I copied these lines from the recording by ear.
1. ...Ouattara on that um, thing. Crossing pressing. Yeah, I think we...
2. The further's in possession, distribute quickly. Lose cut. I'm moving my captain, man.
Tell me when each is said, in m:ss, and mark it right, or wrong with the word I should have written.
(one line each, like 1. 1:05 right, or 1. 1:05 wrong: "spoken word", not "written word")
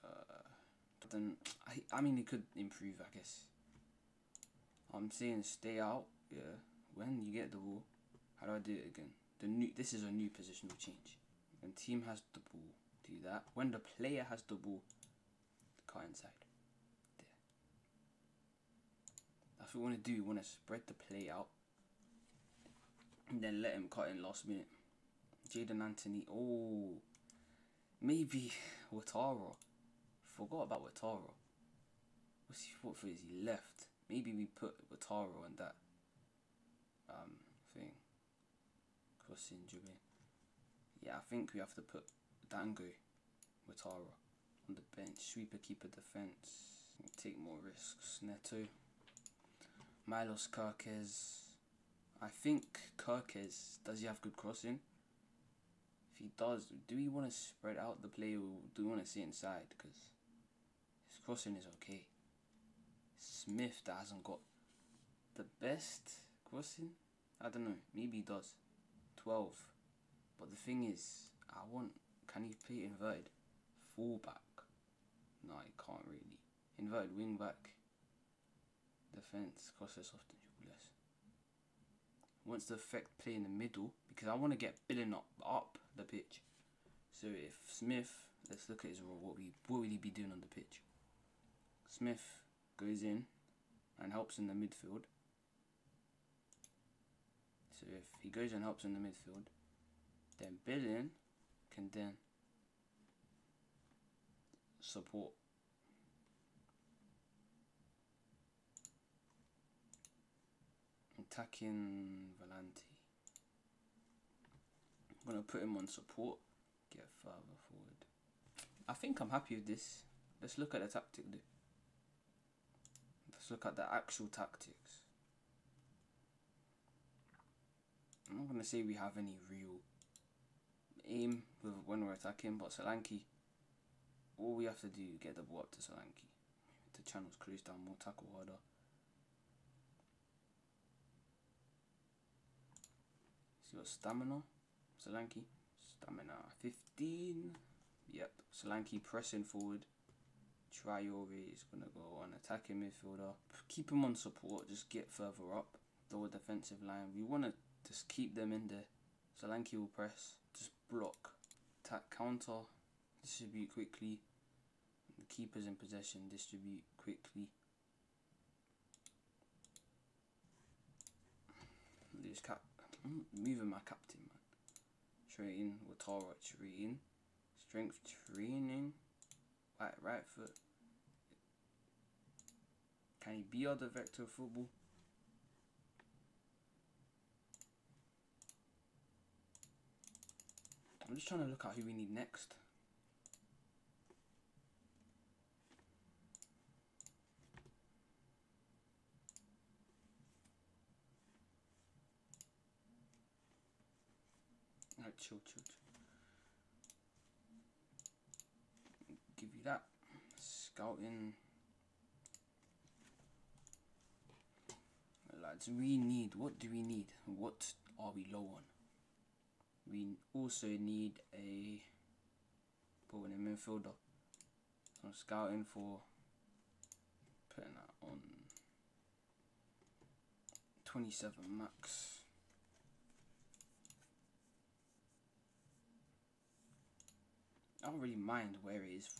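1. 0:34 wrong: "dribbling", not "pressing"
2. 2:45 wrong: "keeper", not "further".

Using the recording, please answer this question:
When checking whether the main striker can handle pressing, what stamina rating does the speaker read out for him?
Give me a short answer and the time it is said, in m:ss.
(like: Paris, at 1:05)
15, at 2:25.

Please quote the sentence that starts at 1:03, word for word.
Smith that hasn't got the best crossing.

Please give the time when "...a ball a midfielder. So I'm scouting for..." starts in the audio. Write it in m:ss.
3:41.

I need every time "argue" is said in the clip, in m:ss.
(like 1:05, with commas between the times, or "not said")
not said.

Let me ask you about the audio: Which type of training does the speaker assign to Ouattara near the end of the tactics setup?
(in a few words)
Strength training.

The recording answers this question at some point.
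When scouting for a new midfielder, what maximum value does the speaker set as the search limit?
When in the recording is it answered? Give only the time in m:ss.
3:50.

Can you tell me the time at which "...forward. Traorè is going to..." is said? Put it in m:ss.
2:29.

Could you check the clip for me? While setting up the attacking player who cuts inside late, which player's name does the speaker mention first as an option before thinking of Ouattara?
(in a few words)
Jaidon Anthony.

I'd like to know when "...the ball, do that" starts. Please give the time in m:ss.
0:12.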